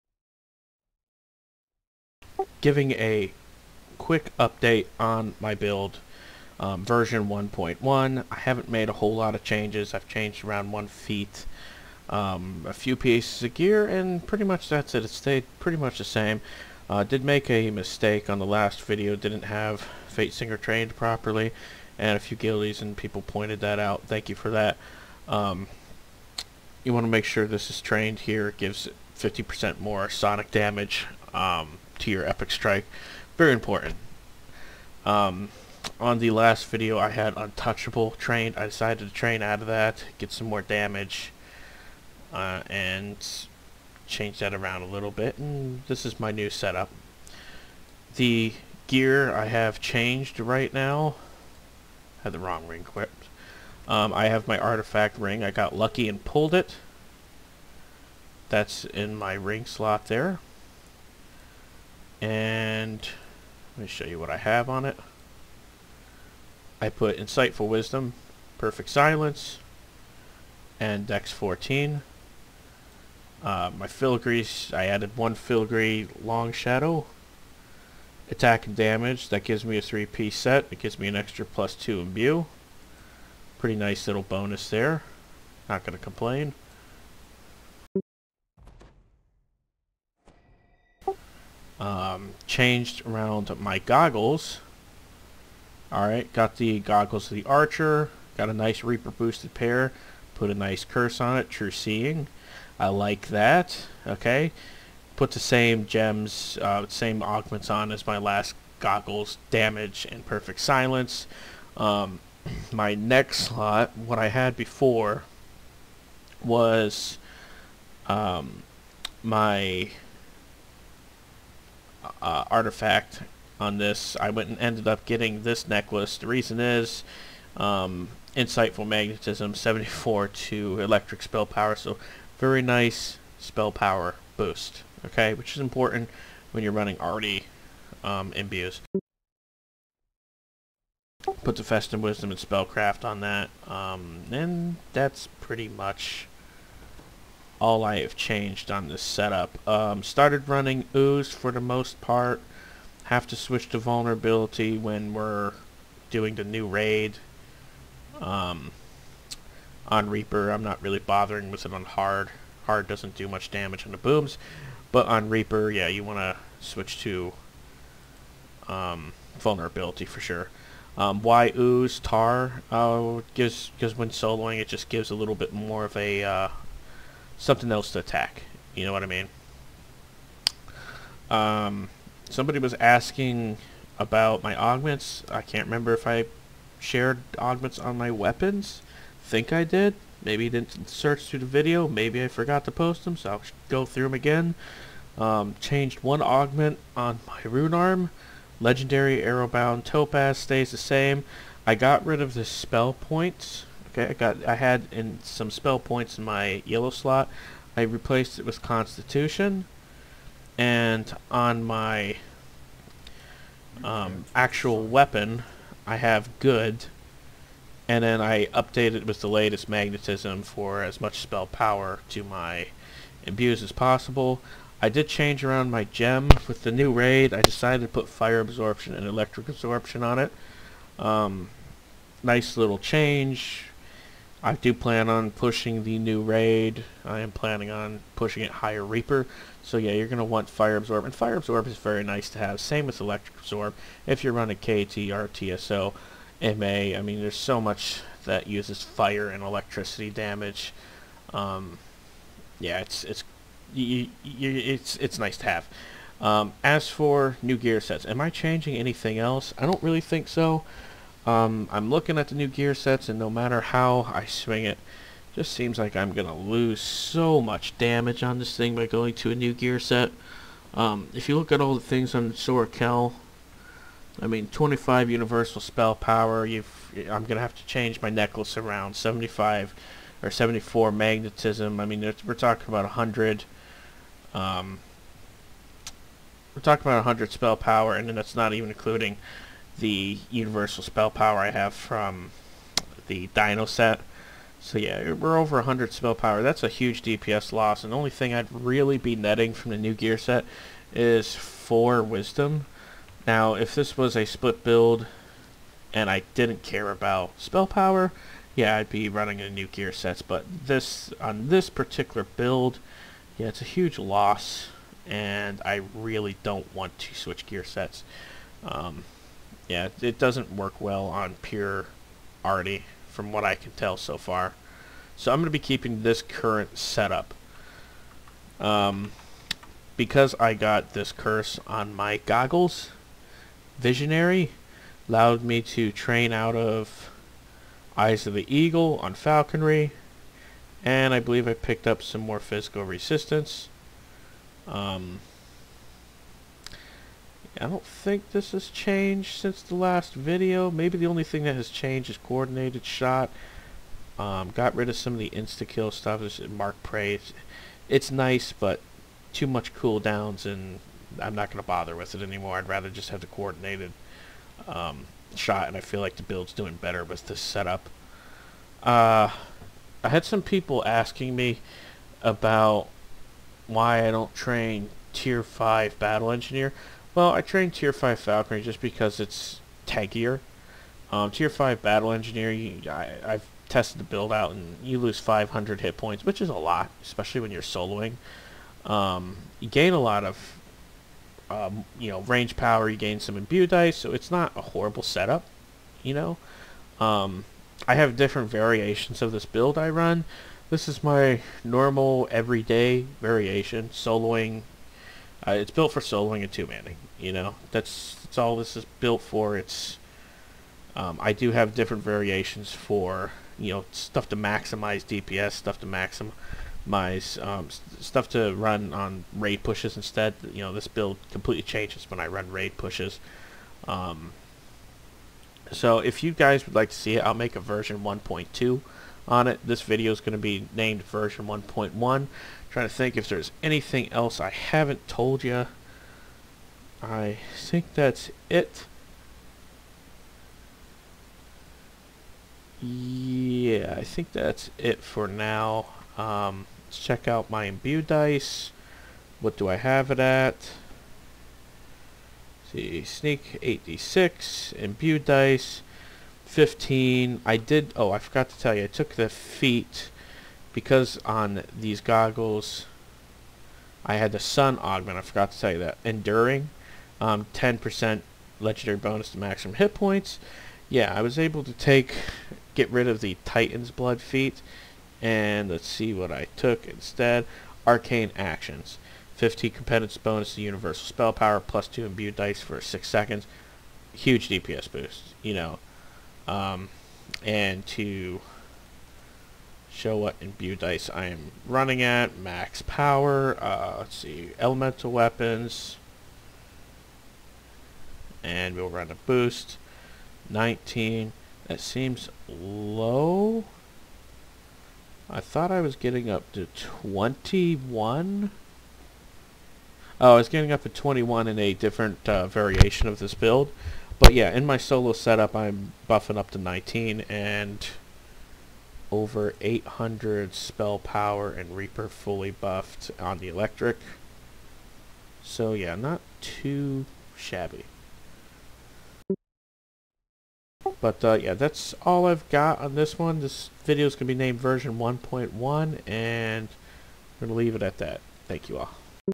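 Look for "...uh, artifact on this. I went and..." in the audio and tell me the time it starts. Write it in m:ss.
2:02.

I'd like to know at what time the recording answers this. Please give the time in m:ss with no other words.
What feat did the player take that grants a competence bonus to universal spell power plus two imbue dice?
7:57.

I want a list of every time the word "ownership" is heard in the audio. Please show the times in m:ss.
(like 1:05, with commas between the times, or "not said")
not said.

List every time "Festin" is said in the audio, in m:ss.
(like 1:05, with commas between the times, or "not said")
2:21.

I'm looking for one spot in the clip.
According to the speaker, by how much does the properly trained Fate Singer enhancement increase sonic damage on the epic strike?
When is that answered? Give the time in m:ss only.
0:29.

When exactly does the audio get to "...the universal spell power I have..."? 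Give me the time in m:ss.
4:49.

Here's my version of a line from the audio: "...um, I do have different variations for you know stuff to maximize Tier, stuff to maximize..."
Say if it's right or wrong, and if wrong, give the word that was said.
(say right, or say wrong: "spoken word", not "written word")
wrong: "DPS", not "Tier".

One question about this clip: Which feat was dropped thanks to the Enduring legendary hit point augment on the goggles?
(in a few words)
Titan's Blood.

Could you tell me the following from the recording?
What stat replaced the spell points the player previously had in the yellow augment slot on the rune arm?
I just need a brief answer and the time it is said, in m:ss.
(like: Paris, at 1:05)
Constitution, at 3:28.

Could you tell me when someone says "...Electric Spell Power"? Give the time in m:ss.
2:10.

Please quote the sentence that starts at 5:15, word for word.
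And I really don't want to switch gear sets.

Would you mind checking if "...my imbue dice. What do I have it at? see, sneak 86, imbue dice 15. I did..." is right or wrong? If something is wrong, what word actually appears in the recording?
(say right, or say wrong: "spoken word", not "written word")
right.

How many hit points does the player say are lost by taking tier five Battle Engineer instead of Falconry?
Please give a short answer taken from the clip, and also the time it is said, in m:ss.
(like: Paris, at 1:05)
500, at 6:25.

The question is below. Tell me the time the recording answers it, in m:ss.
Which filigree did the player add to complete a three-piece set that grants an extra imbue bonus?
1:16.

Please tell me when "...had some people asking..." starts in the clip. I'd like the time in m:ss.
6:10.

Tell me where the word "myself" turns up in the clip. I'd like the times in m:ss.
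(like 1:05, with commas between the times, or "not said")
not said.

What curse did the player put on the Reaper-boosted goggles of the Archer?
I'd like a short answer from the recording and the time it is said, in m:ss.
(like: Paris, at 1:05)
True Seeing, at 1:41.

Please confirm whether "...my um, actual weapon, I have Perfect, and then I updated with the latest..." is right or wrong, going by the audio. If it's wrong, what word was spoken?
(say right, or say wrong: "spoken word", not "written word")
wrong: "Good", not "Perfect".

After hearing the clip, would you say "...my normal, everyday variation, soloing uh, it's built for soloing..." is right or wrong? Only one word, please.
right.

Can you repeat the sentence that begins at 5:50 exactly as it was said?
Maybe the only thing that has changed is coordinated shot.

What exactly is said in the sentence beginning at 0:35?
Um, on the last video I had untouchable trained.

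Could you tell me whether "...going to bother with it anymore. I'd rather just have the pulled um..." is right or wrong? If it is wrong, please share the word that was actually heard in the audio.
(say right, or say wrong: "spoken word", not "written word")
wrong: "coordinated", not "pulled".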